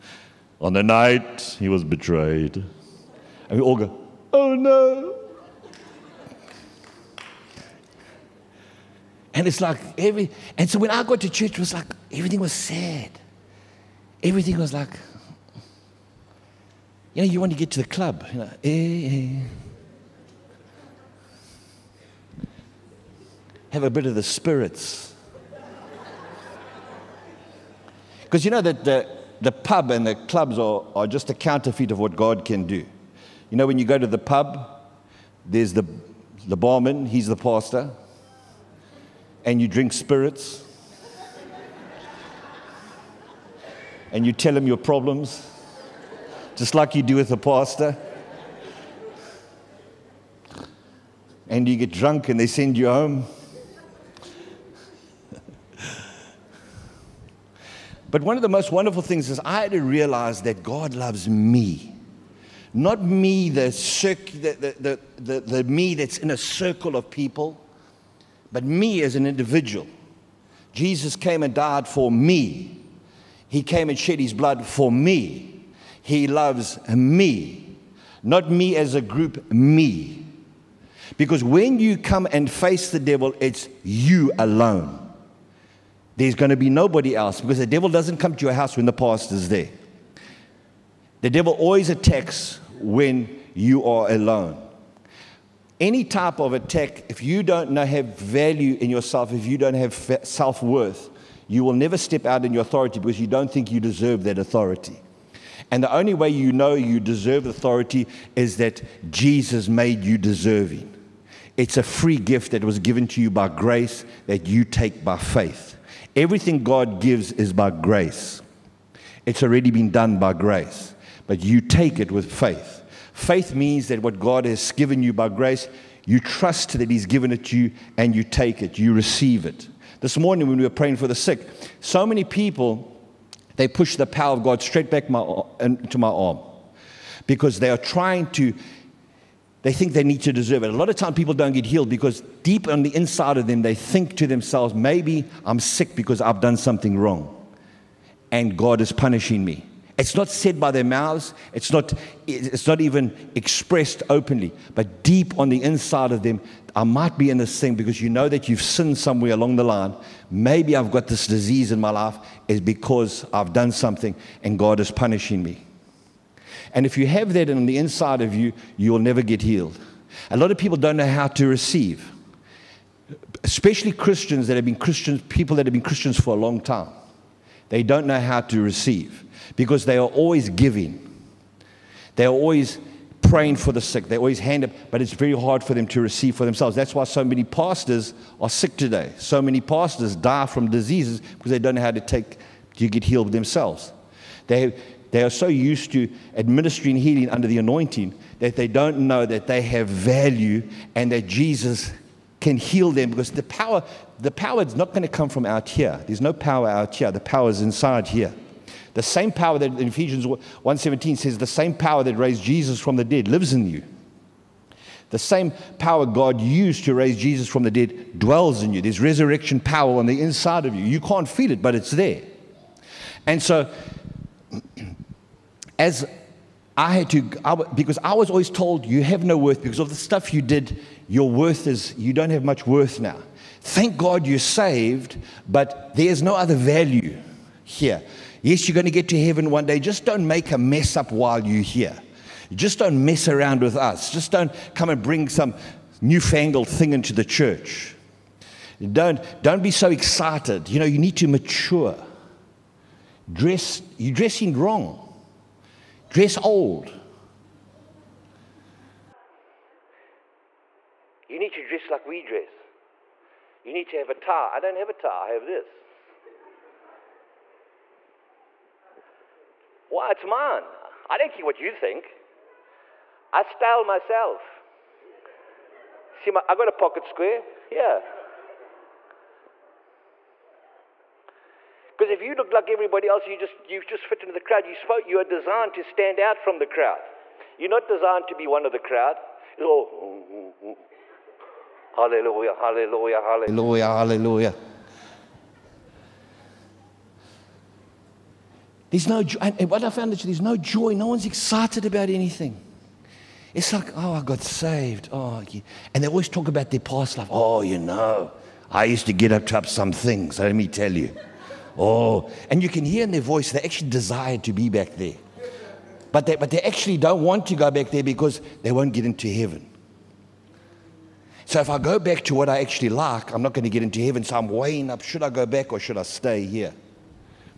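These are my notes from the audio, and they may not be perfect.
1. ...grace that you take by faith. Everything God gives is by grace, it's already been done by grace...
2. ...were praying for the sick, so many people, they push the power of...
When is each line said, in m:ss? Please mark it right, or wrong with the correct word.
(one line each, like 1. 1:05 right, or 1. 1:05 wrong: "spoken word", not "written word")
1. 1:53 right
2. 2:10 right.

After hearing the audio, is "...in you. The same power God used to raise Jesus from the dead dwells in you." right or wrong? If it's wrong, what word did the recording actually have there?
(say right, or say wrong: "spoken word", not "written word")
right.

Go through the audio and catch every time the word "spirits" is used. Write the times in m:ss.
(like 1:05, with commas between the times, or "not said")
0:24, 0:39.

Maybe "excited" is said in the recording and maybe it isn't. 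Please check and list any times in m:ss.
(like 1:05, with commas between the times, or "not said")
4:09, 5:01.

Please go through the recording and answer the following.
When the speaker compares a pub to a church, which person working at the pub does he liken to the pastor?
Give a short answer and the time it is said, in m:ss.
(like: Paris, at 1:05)
The barman, at 0:36.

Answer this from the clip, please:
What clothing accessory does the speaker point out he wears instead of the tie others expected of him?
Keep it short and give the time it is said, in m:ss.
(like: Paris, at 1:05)
A pocket square, at 4:36.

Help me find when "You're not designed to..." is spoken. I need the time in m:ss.
4:47.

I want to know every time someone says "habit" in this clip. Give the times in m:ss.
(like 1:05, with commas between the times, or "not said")
not said.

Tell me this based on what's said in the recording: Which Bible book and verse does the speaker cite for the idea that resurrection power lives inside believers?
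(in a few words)
Ephesians 1:17.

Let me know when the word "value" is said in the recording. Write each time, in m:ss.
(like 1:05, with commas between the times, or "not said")
1:38, 3:19, 3:56.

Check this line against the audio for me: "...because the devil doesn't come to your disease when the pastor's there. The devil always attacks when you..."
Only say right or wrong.
wrong.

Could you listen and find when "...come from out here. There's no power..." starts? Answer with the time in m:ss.
3:25.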